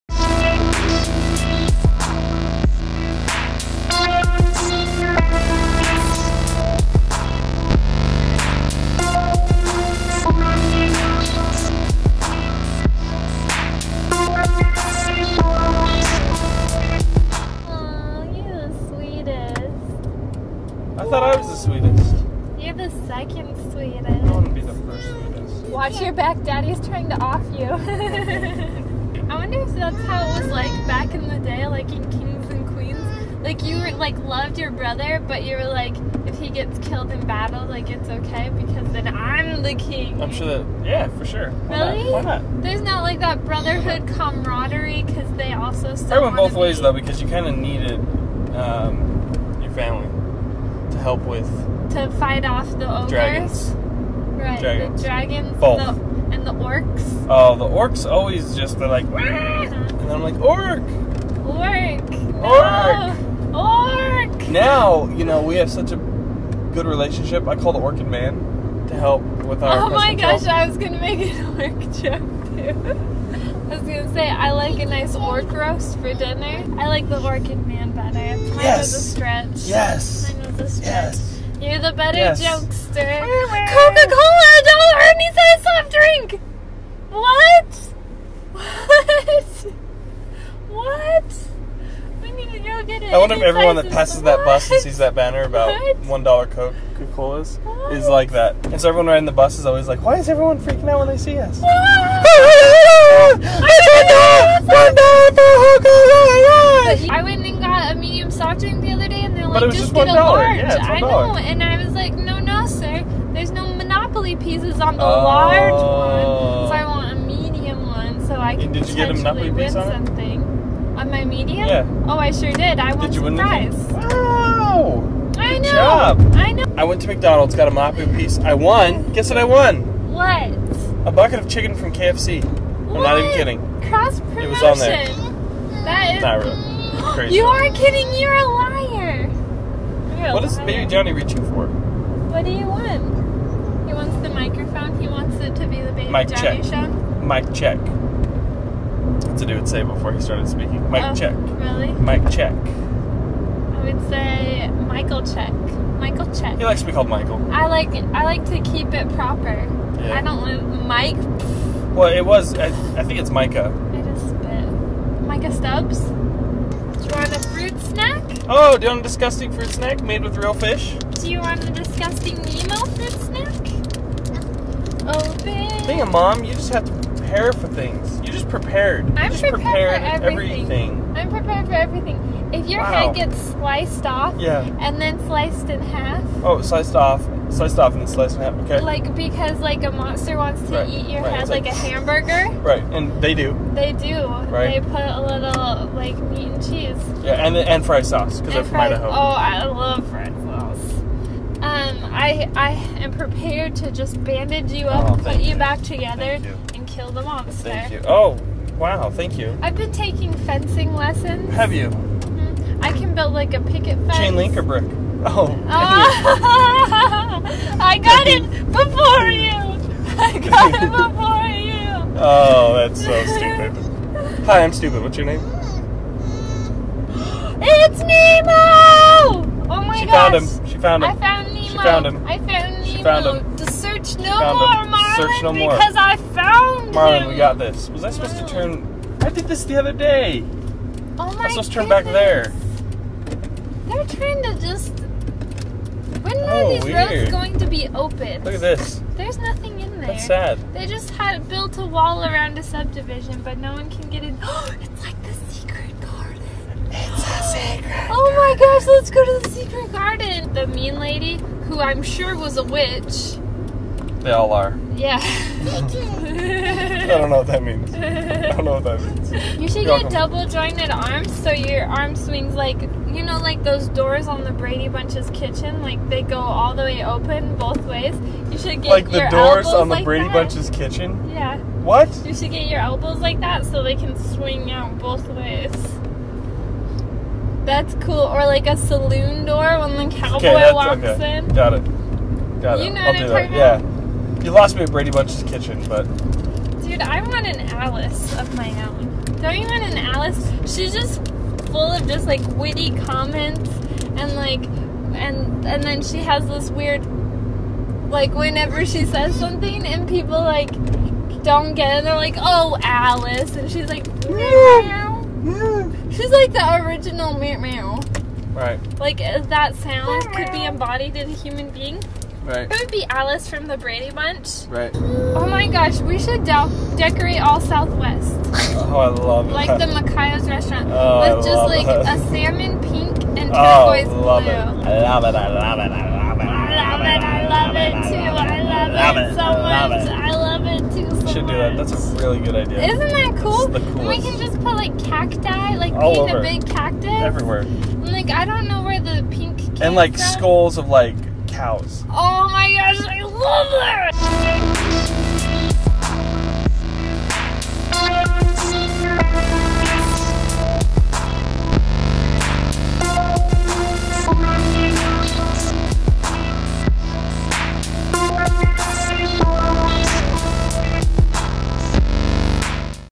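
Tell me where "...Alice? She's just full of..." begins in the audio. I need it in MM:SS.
04:59.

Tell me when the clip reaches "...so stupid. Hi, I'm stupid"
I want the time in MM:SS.
03:43.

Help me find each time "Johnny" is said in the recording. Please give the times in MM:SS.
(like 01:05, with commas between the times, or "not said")
02:20, 02:26.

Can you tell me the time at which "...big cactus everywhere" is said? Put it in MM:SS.
05:46.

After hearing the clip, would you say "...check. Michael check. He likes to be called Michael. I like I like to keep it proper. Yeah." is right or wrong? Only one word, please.
right.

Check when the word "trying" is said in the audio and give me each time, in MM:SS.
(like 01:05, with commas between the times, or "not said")
00:26, 04:04.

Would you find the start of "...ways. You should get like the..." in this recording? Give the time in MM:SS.
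04:37.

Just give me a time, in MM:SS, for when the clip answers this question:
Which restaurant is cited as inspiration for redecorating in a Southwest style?
05:29.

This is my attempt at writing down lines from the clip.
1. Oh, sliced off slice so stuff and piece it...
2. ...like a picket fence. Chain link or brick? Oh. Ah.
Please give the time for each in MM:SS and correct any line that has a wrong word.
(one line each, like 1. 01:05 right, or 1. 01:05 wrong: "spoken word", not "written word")
1. 03:06 wrong: "slice", not "piece"
2. 03:33 right.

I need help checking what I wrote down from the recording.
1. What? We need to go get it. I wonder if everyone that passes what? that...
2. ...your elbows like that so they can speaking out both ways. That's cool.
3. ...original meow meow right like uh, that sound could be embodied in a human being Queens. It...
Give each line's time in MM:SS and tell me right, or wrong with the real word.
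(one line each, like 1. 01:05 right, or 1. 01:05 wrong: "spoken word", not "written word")
1. 01:30 right
2. 04:42 wrong: "swing", not "speaking"
3. 05:16 wrong: "Right", not "Queens".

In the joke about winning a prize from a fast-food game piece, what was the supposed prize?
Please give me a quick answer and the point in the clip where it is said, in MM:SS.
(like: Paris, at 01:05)
A bucket of chicken from KFC, at 02:11.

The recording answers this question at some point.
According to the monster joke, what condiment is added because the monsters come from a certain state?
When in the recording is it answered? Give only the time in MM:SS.
03:17.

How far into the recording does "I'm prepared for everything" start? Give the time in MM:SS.
03:01.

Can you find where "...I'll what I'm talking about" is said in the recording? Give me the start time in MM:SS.
04:53.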